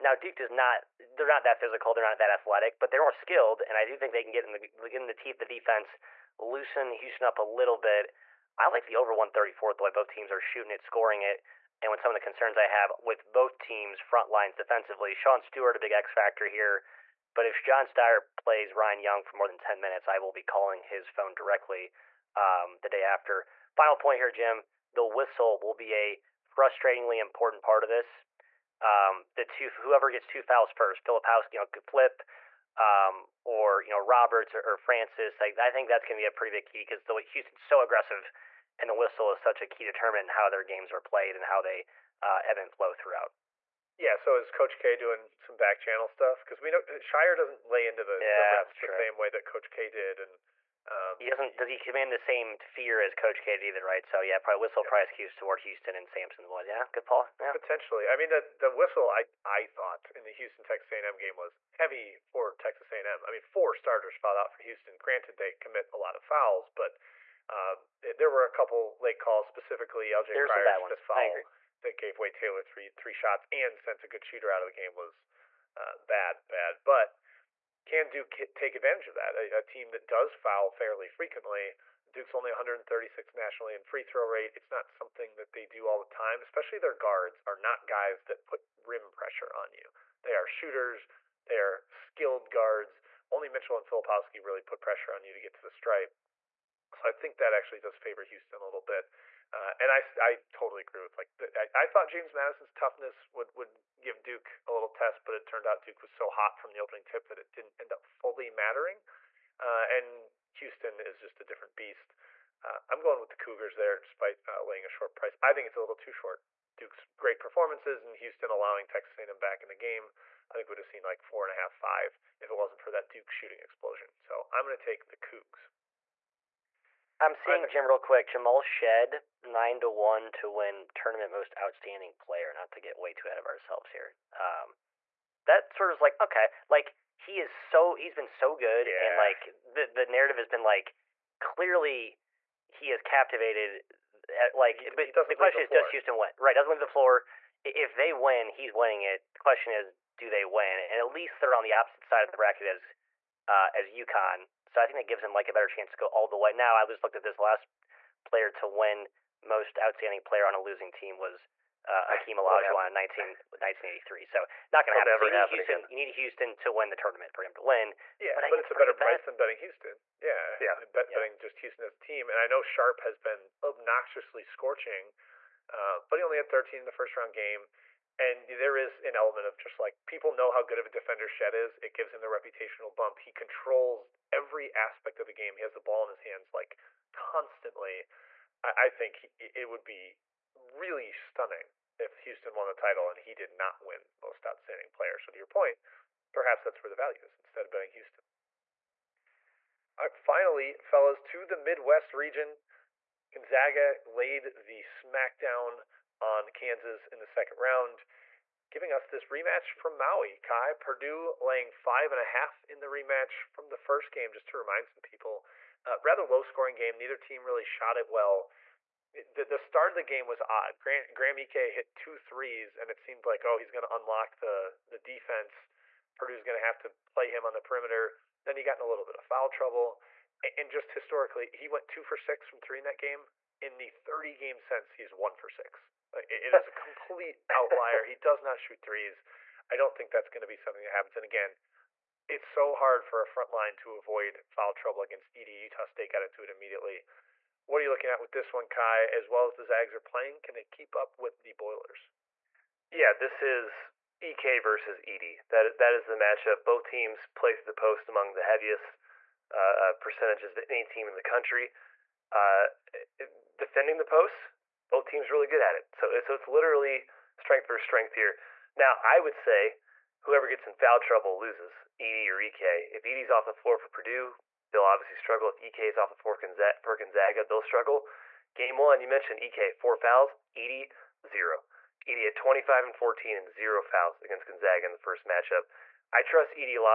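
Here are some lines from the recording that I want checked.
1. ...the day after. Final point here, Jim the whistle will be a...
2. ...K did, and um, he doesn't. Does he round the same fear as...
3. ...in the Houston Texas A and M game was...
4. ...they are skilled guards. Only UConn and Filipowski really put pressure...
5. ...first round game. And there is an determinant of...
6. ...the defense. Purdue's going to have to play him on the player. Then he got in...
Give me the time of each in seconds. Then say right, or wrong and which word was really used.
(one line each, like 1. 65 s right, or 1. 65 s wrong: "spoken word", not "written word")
1. 22 s right
2. 49 s wrong: "command", not "round"
3. 60 s right
4. 91 s wrong: "Mitchell", not "UConn"
5. 176 s wrong: "element", not "determinant"
6. 224 s wrong: "perimeter", not "player".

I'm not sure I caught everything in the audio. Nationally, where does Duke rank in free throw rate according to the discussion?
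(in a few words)
136.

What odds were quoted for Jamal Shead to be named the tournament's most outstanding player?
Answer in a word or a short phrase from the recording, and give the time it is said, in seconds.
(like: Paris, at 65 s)
9 to 1, at 129 s.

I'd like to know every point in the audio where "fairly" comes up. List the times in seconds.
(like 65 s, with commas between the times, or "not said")
80 s.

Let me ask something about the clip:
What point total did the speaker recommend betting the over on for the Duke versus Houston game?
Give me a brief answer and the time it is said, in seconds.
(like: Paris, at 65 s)
134, at 8 s.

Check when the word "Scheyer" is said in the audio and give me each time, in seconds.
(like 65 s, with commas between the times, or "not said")
17 s, 46 s.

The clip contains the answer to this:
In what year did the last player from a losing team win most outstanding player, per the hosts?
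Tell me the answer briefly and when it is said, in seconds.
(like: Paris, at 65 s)
1983, at 163 s.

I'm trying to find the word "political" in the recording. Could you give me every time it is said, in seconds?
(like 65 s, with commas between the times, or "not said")
not said.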